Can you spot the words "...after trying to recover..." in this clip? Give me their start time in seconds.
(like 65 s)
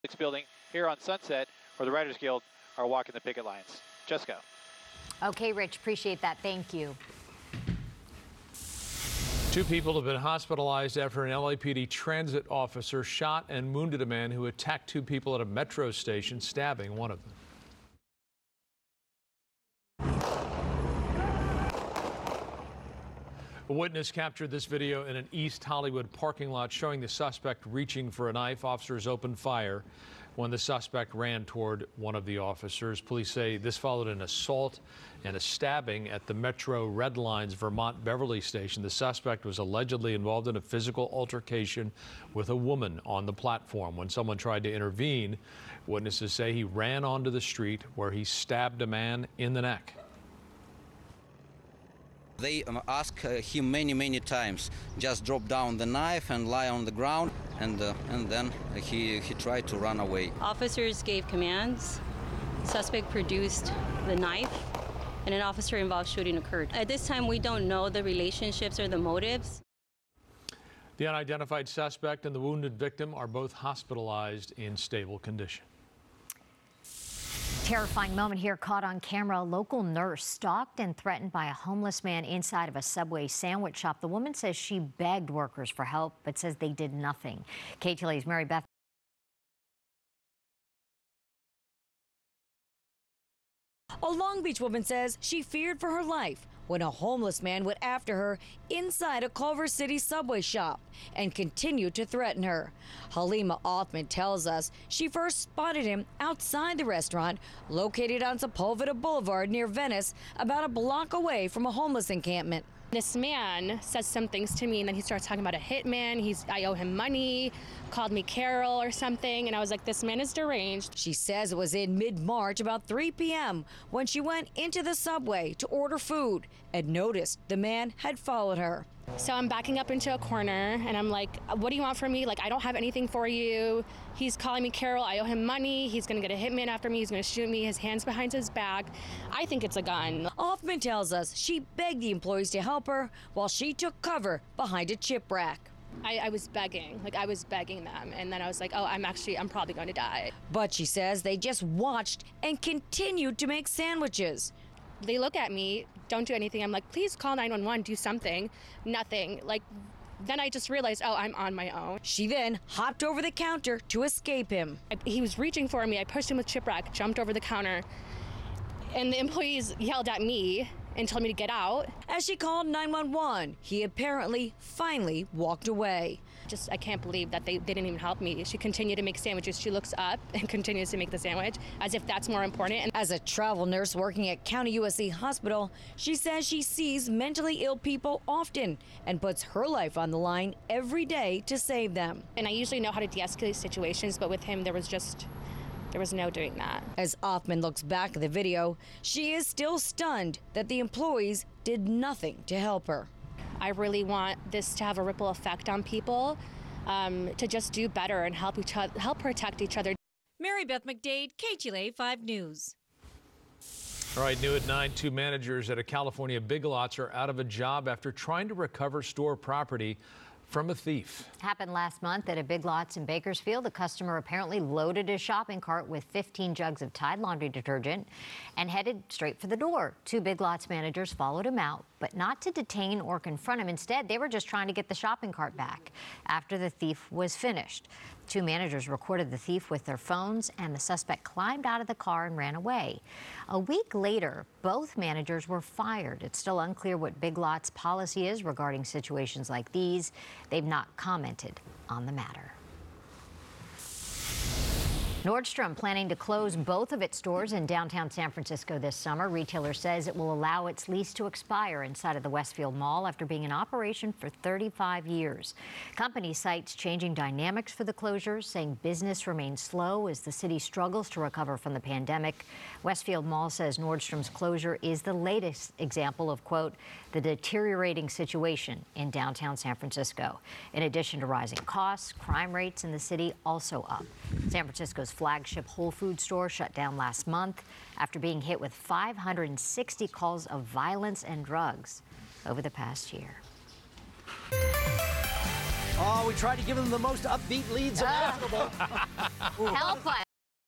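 217 s.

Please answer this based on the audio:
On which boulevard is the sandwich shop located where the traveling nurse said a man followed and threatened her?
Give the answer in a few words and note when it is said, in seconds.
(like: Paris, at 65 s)
Sepulveda Boulevard, at 108 s.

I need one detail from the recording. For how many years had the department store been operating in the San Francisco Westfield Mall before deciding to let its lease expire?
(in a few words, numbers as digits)
35.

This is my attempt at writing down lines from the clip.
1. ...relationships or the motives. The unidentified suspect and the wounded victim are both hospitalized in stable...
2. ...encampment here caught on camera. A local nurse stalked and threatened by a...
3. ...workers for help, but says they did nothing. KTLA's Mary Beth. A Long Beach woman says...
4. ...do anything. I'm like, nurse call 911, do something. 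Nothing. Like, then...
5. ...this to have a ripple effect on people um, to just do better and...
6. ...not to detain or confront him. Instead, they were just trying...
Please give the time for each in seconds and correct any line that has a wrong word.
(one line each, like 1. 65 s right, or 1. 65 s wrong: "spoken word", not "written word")
1. 68 s right
2. 78 s wrong: "moment", not "encampment"
3. 85 s right
4. 156 s wrong: "please", not "nurse"
5. 204 s right
6. 232 s right.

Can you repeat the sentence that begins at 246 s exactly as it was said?
It's still unclear what Big Lots policy is regarding situations like these.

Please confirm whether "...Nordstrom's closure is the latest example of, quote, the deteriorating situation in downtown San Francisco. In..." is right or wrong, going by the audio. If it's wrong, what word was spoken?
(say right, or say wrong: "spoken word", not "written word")
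right.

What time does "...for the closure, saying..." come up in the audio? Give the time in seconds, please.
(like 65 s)
267 s.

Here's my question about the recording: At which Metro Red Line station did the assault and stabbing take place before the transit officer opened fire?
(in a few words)
Vermont Beverly.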